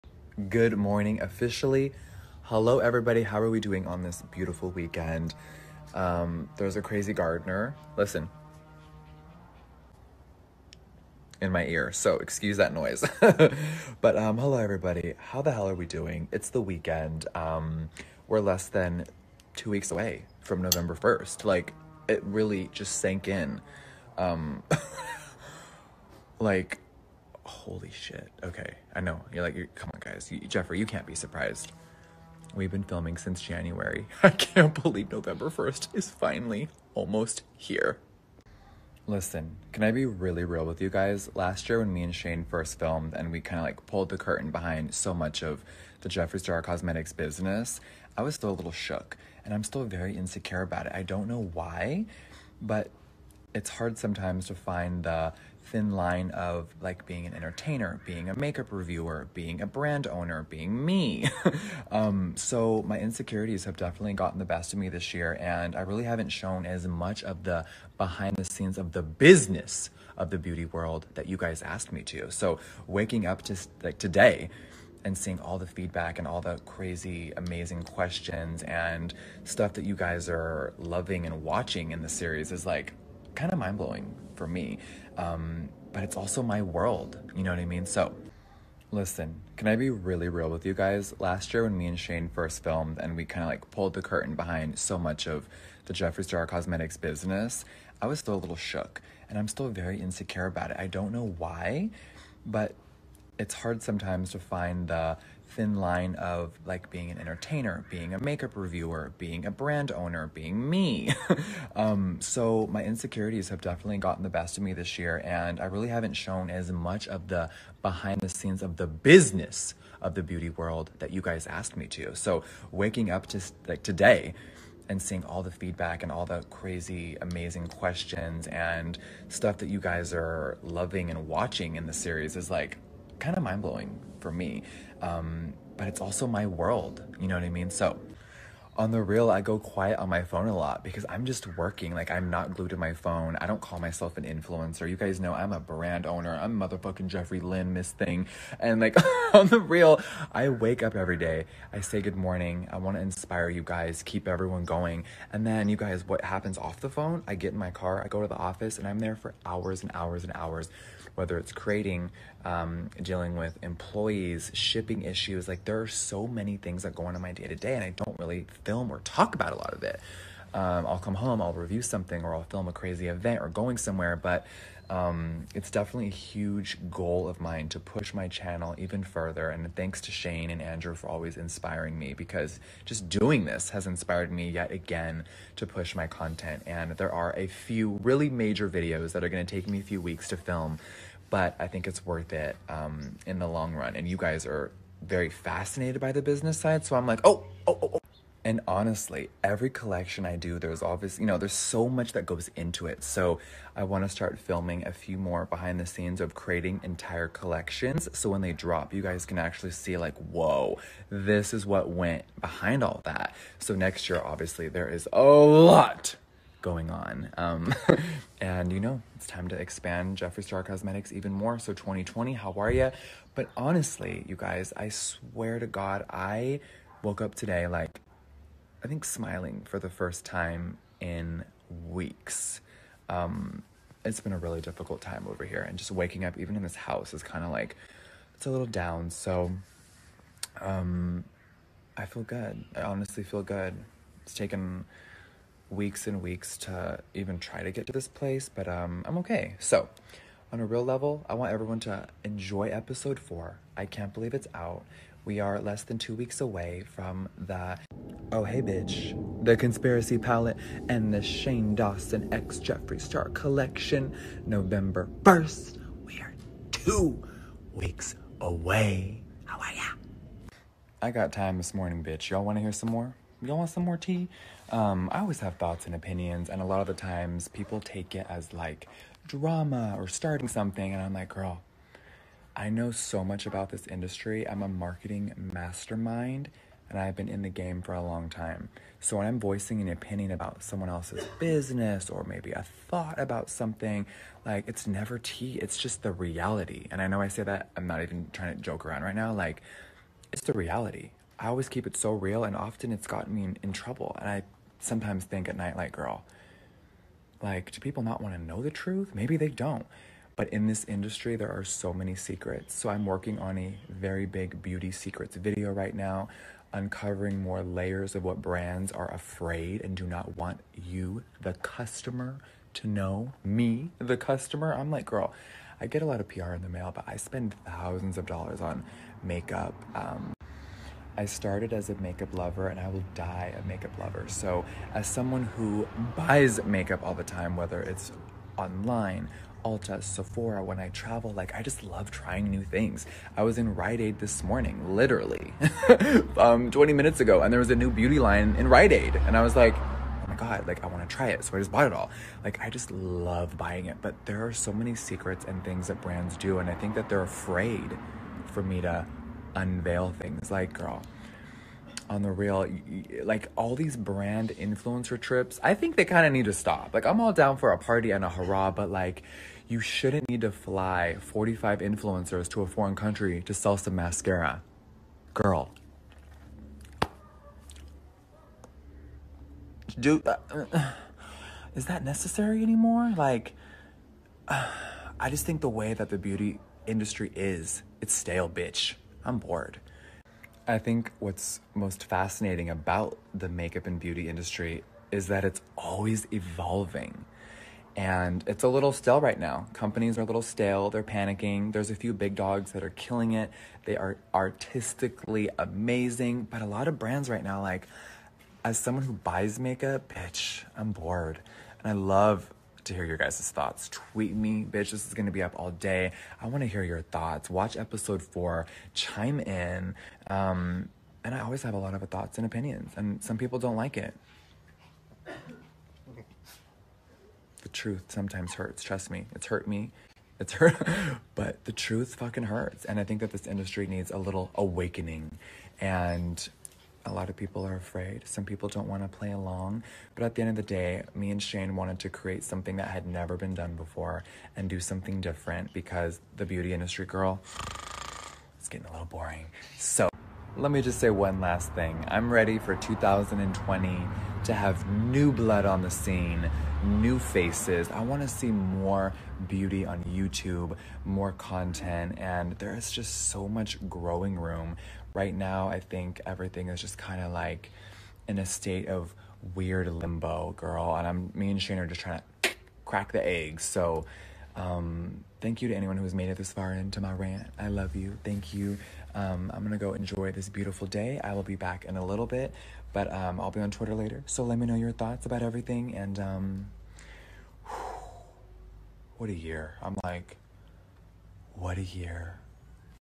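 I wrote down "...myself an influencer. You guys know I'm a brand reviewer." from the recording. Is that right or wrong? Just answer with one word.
wrong.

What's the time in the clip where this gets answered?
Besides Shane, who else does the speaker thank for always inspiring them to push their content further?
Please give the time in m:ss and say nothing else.
3:00.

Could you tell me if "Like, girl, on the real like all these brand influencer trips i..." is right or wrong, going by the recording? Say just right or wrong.
right.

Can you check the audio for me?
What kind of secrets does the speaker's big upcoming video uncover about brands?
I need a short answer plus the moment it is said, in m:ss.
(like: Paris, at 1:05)
Beauty secrets, at 5:14.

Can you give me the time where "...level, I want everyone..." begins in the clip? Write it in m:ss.
4:10.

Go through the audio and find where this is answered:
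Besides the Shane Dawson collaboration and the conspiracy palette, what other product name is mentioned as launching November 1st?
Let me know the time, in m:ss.
4:18.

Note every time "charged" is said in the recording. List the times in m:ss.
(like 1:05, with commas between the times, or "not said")
not said.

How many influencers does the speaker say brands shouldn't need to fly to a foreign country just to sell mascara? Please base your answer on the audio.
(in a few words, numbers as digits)
45.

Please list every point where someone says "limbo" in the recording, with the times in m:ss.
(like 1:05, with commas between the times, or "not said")
7:49.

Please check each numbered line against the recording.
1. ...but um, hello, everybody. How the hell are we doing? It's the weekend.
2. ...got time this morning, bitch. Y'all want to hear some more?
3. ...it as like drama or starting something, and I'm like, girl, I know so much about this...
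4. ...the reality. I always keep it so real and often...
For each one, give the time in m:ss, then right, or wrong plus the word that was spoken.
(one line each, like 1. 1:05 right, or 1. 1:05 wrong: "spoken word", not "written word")
1. 0:13 right
2. 4:31 right
3. 4:38 right
4. 5:00 right.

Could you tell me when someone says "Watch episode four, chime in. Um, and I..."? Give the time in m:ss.
6:57.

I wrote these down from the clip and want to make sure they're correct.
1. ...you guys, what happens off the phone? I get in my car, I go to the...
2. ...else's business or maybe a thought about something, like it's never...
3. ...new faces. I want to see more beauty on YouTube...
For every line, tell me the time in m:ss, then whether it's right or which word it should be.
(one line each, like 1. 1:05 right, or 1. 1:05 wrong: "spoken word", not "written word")
1. 2:35 right
2. 4:50 right
3. 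7:36 right.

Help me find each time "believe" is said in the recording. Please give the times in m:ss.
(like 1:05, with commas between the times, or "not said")
0:34, 4:14.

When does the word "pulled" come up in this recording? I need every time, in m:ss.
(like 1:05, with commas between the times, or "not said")
0:43, 1:33.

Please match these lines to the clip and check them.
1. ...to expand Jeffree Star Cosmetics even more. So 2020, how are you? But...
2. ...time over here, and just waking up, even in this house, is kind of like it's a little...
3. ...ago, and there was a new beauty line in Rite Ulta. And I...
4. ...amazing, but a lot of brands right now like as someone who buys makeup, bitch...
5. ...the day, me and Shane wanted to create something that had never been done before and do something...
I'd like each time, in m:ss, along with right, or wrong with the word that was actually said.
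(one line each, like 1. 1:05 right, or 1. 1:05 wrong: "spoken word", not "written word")
1. 3:39 right
2. 3:55 right
3. 5:47 wrong: "Aid", not "Ulta"
4. 6:45 right
5. 7:20 right.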